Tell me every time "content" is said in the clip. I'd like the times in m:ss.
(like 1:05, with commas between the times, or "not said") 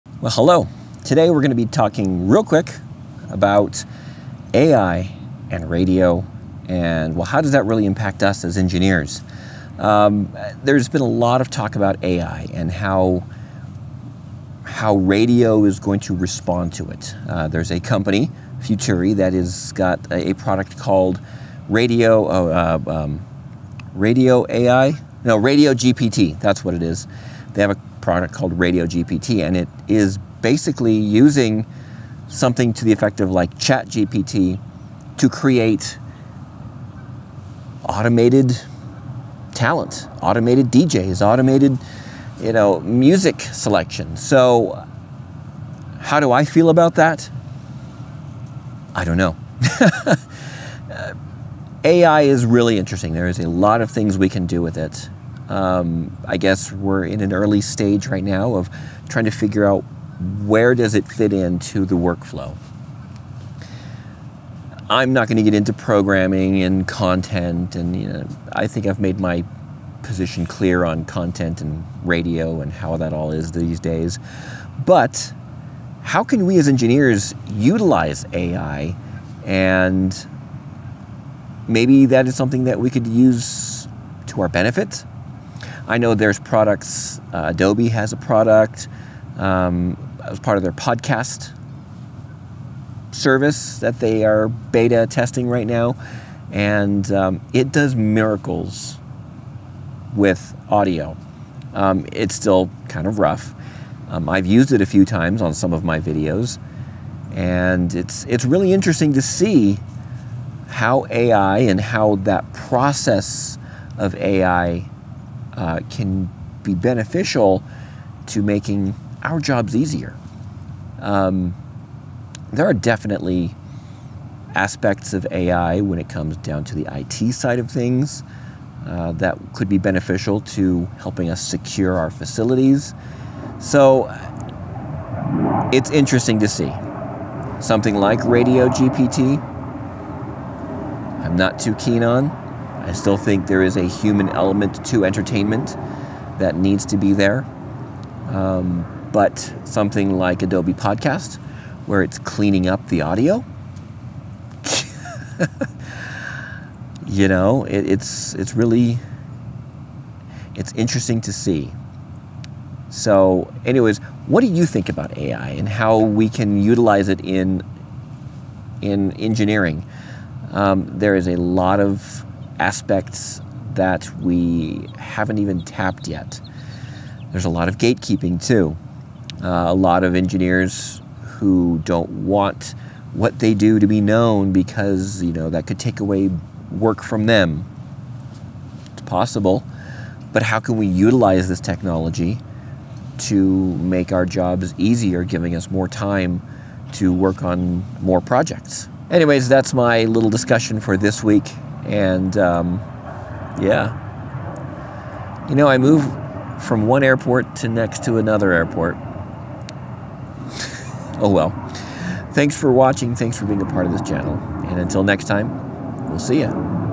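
1:06, 1:11.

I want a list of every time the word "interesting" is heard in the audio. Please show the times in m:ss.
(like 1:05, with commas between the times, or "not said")
0:52, 1:48, 2:15, 2:40.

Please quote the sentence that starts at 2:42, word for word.
So, anyways, what do you think about AI and how we can utilize it in in engineering?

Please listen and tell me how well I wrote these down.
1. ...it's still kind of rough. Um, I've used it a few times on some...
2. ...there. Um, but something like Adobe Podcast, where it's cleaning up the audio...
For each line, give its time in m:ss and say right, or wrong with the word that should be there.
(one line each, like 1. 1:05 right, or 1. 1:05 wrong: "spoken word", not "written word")
1. 1:42 right
2. 2:27 right.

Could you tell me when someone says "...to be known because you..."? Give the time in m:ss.
3:03.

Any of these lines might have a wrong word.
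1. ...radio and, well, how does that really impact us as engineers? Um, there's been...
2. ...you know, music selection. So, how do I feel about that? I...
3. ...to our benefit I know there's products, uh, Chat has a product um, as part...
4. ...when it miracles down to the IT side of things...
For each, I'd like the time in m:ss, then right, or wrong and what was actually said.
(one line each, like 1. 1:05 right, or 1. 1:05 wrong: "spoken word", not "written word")
1. 0:05 right
2. 0:42 right
3. 1:24 wrong: "Adobe", not "Chat"
4. 2:05 wrong: "comes", not "miracles".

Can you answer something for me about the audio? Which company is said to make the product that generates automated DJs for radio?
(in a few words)
Futuri.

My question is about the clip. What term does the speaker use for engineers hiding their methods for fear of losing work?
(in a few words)
Gatekeeping.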